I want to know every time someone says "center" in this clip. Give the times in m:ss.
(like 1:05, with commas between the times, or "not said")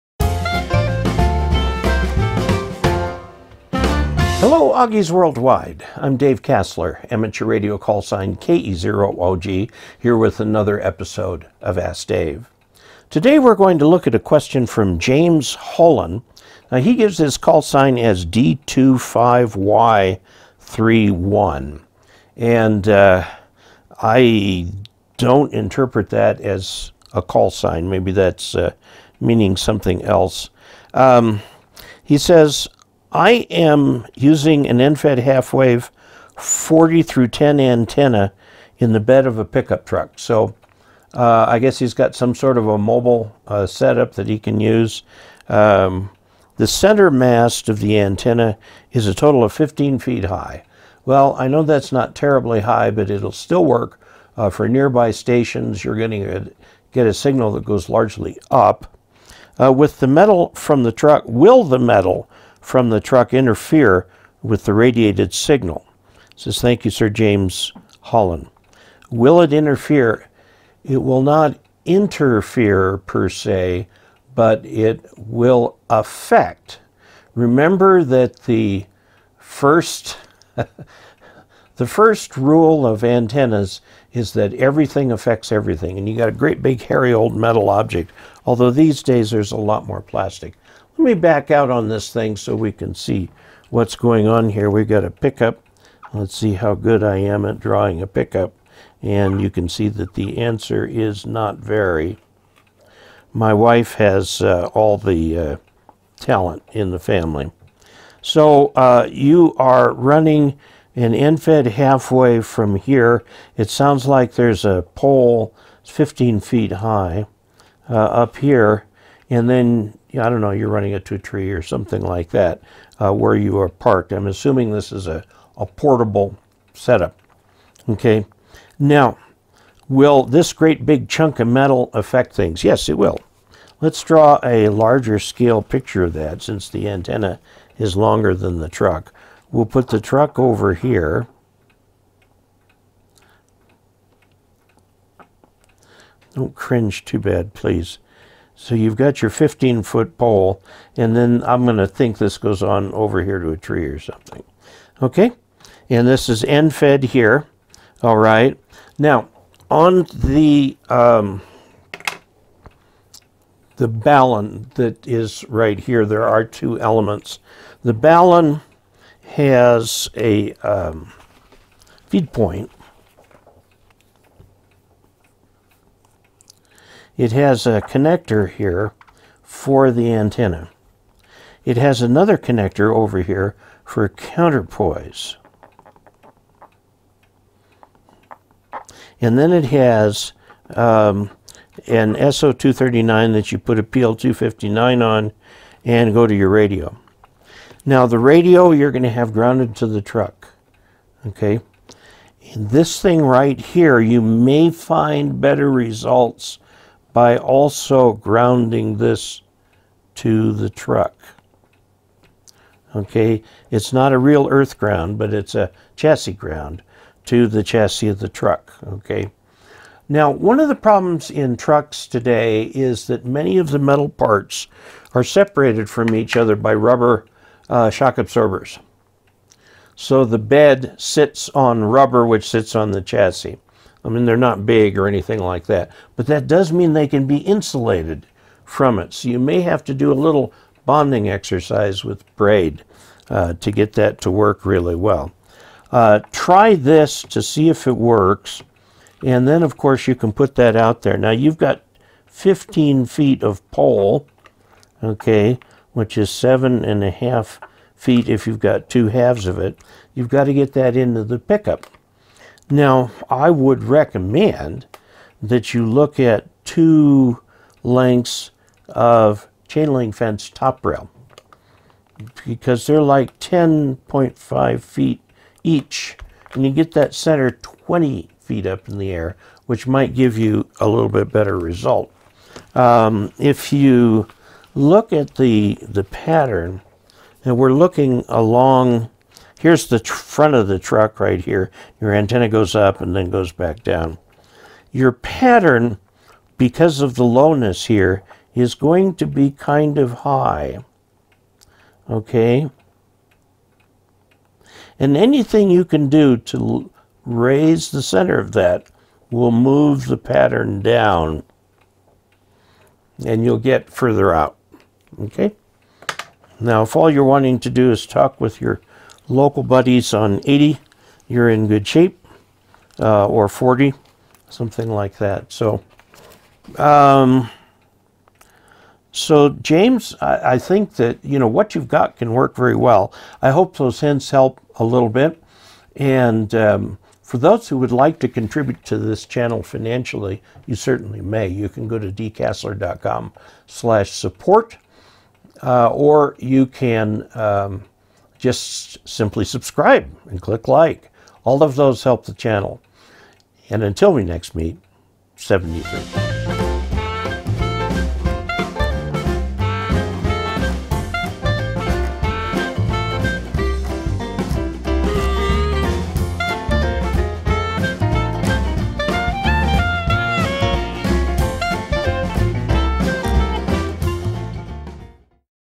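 0:46, 4:37, 5:08.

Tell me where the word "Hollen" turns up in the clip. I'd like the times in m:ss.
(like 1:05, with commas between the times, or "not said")
0:15, 1:08.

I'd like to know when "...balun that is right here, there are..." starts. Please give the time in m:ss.
2:43.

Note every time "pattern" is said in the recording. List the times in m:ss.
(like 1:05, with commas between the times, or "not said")
4:46, 4:55, 5:10.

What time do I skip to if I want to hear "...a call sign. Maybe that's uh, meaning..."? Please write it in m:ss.
0:27.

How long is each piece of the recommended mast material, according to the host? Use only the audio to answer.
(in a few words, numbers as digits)
10.5 feet.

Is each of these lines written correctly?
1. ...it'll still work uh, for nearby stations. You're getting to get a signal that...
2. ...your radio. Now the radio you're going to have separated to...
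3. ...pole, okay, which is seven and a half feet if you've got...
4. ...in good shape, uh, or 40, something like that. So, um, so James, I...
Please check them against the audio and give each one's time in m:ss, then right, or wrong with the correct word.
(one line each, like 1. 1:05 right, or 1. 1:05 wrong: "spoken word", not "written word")
1. 0:53 right
2. 3:16 wrong: "grounded", not "separated"
3. 4:13 right
4. 5:21 right.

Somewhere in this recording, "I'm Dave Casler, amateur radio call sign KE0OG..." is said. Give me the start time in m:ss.
0:05.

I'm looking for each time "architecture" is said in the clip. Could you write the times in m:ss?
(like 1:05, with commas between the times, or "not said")
not said.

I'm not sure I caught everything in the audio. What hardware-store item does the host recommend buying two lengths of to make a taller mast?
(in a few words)
Chain link fence top rail.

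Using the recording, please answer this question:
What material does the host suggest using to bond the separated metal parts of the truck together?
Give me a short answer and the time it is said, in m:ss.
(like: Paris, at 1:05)
Braid, at 4:02.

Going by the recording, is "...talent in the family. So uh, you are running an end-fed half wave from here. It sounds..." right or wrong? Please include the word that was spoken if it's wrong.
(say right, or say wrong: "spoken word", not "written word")
right.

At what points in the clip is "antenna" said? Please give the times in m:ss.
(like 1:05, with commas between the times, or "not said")
0:37, 0:47, 1:23, 2:16, 3:00, 4:52.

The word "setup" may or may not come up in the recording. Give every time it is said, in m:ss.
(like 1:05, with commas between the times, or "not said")
0:43, 2:06.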